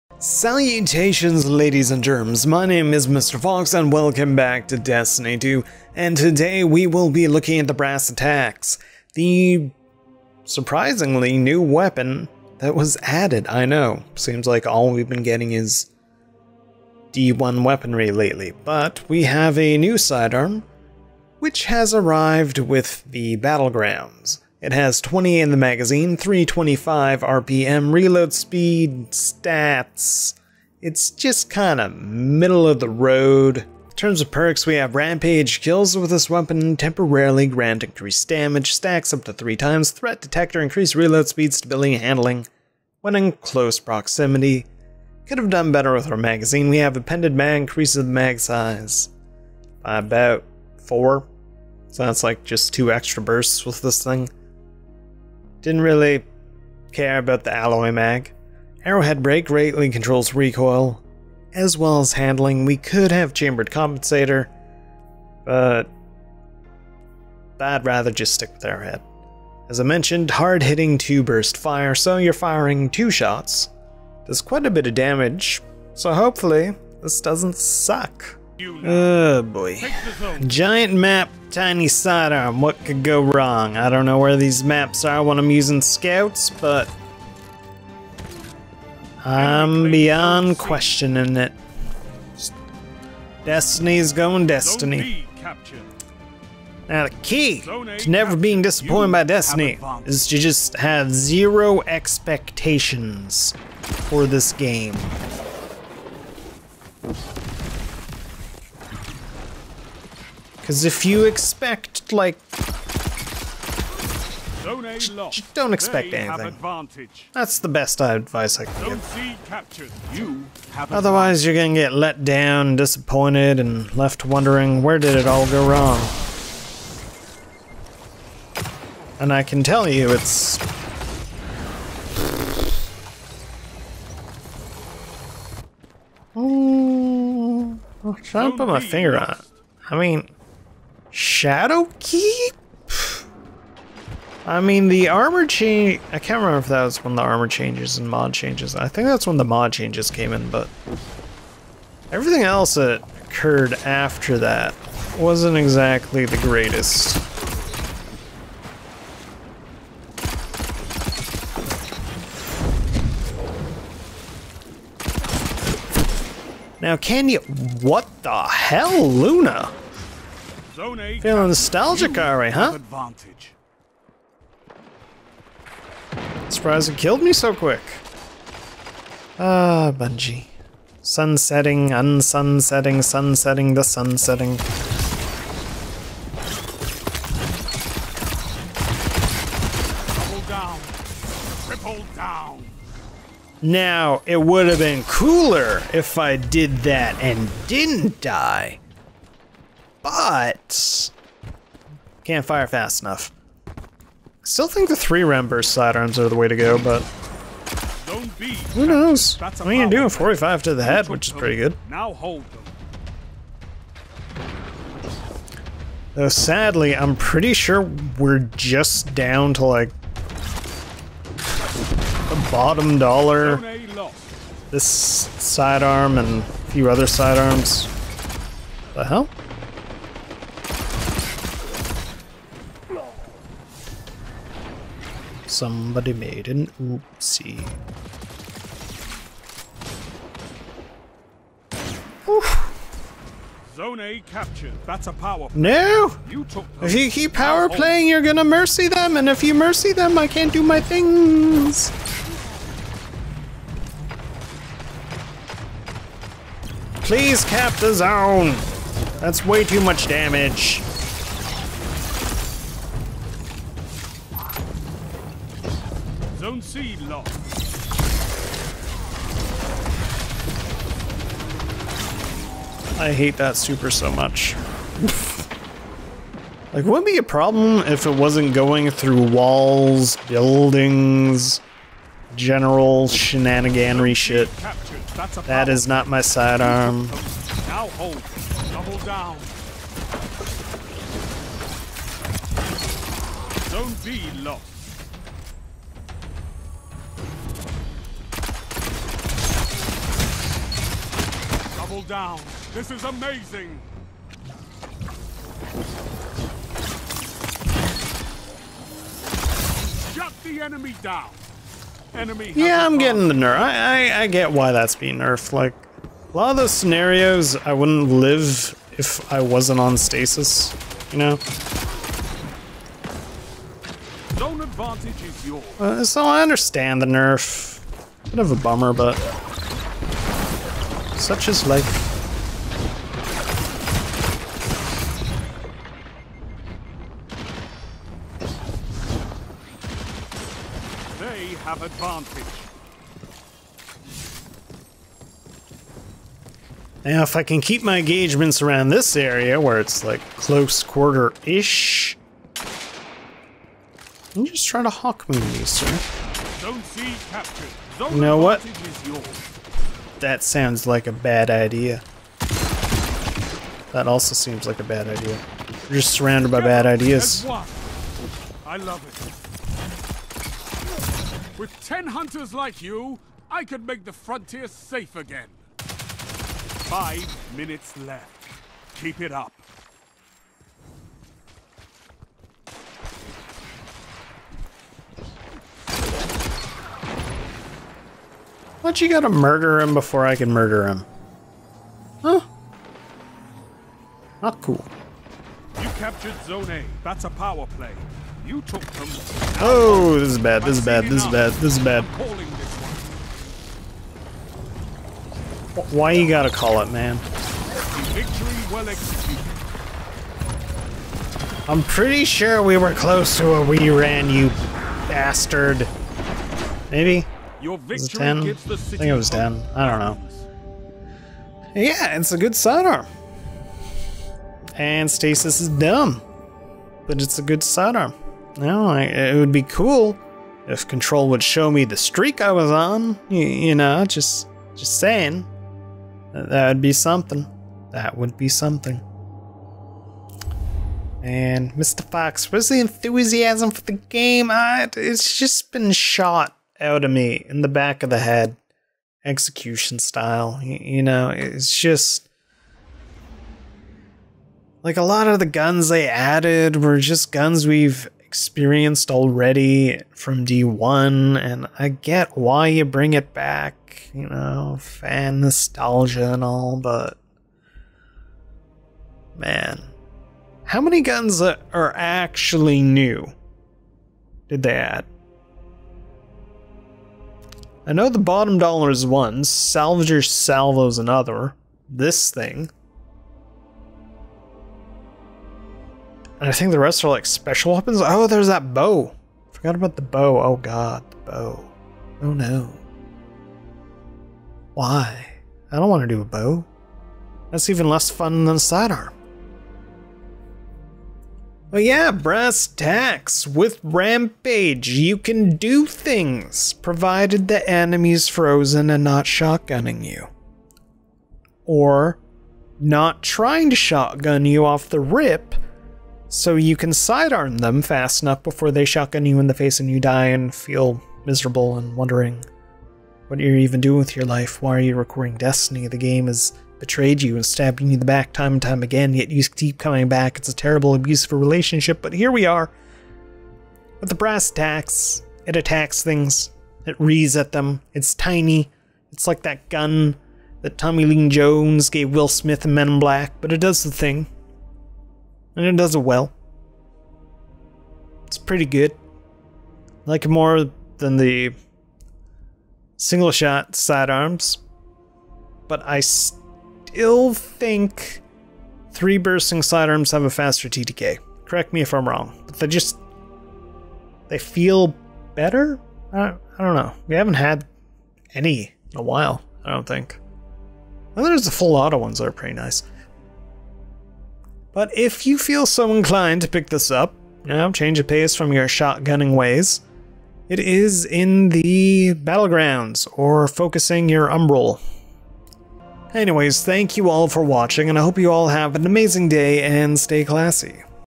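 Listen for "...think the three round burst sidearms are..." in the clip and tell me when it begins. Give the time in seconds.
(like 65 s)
204 s.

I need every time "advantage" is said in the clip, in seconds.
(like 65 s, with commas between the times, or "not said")
172 s, 324 s, 341 s.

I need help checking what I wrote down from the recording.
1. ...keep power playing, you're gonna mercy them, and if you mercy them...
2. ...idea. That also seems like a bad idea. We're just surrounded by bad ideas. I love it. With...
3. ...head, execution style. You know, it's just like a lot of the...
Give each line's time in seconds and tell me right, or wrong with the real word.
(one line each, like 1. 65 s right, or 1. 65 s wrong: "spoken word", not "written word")
1. 247 s right
2. 361 s right
3. 448 s right.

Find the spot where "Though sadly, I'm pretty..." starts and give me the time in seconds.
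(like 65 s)
216 s.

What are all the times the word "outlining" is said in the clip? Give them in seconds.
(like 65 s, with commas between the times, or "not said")
not said.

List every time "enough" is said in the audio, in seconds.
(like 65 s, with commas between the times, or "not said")
203 s, 518 s.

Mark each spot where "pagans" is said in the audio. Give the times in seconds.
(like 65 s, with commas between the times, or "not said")
not said.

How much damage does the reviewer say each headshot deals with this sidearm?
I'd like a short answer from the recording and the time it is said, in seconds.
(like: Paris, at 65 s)
45, at 210 s.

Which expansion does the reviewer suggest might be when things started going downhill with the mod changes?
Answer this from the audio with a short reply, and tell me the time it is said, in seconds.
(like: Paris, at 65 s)
Shadowkeep, at 141 s.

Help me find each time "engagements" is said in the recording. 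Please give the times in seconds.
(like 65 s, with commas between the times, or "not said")
347 s.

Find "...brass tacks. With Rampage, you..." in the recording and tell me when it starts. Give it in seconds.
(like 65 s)
502 s.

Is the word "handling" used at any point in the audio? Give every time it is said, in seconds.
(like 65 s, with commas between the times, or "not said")
41 s, 62 s.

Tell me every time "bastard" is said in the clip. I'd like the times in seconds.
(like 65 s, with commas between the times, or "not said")
415 s.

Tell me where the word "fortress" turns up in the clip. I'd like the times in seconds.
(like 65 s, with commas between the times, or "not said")
not said.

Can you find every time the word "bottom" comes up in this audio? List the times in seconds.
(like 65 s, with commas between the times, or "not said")
222 s, 478 s.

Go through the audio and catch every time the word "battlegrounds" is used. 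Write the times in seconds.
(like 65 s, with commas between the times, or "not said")
23 s, 582 s.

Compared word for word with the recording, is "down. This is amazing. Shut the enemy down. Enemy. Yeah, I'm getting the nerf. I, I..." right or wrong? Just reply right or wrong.
right.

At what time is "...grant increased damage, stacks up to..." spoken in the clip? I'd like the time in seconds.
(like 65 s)
37 s.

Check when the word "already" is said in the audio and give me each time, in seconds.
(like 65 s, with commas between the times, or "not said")
459 s.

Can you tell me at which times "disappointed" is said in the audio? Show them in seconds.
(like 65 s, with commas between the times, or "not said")
98 s, 122 s.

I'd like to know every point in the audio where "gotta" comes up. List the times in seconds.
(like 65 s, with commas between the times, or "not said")
389 s, 406 s.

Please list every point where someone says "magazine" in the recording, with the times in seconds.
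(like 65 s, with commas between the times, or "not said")
25 s, 46 s.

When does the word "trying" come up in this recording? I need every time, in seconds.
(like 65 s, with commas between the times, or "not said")
138 s, 354 s, 513 s.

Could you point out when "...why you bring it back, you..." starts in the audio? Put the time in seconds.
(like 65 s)
462 s.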